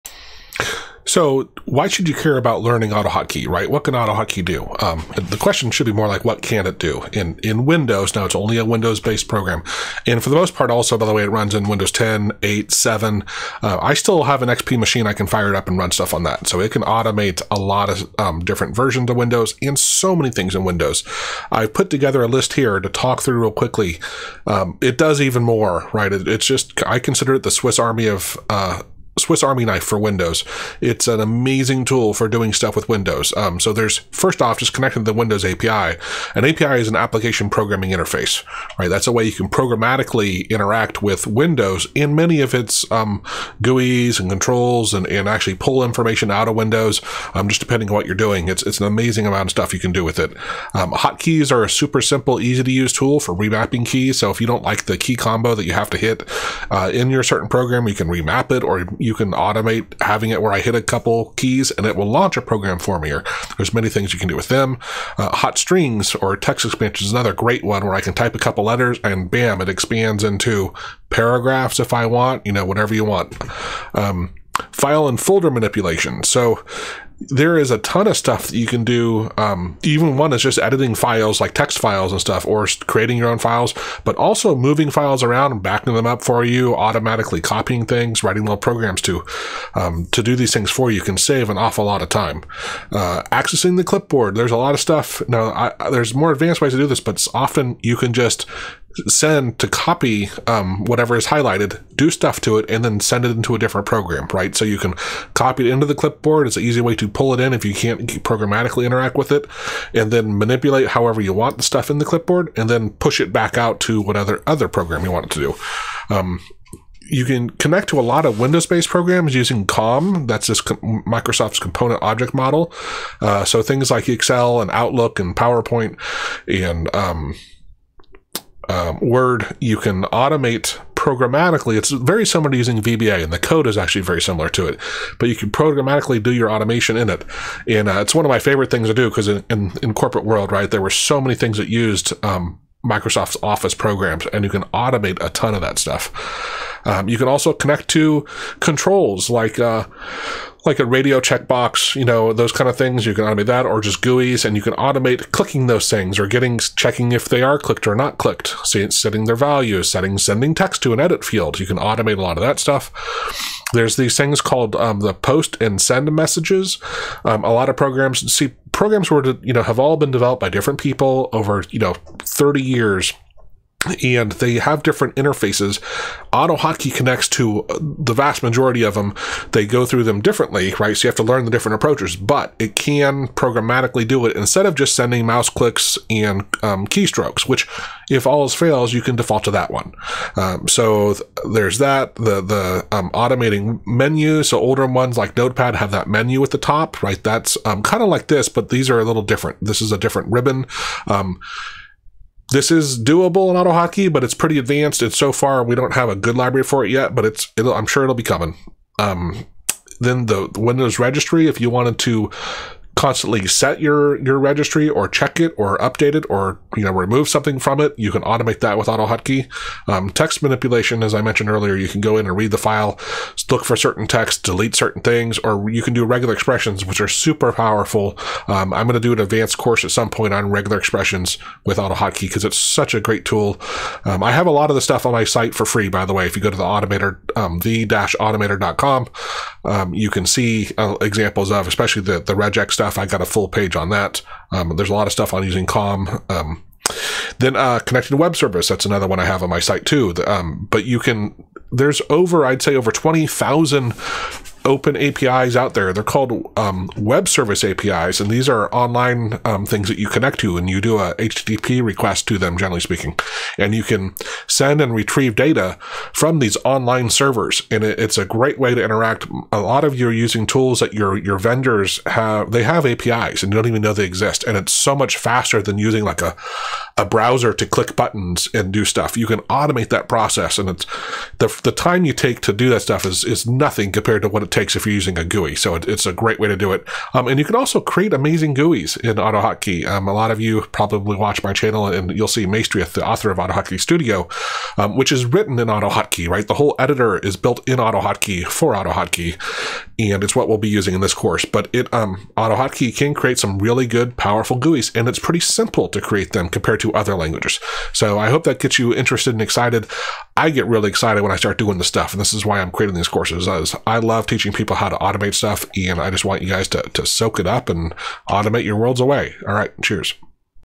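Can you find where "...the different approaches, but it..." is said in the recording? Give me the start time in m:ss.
3:01.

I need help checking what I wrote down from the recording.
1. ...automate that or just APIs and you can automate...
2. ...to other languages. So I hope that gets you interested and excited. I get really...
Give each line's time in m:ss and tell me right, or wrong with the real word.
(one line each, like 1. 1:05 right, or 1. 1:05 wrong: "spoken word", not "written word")
1. 2:33 wrong: "GUIs", not "APIs"
2. 5:06 right.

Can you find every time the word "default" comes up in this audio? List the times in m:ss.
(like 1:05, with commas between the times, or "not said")
3:09.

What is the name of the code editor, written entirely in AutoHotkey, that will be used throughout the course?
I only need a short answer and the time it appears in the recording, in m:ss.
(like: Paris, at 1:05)
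AutoHotkey Studio, at 4:53.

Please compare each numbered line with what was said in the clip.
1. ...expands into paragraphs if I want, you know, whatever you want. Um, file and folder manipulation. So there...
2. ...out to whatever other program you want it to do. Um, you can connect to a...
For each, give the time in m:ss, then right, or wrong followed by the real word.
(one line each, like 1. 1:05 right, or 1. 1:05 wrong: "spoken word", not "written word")
1. 1:09 right
2. 1:53 right.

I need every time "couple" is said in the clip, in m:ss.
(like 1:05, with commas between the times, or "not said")
1:00, 1:08.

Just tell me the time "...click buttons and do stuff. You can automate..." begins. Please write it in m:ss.
4:37.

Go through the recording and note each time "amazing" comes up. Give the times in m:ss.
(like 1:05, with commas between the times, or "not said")
0:31, 0:48, 4:48.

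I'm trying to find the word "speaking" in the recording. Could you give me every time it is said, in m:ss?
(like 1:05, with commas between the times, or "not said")
4:22.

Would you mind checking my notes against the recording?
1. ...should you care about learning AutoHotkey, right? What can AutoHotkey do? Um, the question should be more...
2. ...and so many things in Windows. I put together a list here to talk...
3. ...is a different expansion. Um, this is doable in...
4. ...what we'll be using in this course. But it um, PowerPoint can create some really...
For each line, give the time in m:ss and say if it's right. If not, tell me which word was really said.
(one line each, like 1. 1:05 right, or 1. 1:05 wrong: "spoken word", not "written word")
1. 0:01 right
2. 0:19 right
3. 3:19 wrong: "ribbon", not "expansion"
4. 5:00 wrong: "AutoHotkey", not "PowerPoint".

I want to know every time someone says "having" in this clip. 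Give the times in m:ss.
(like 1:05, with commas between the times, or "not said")
1:00.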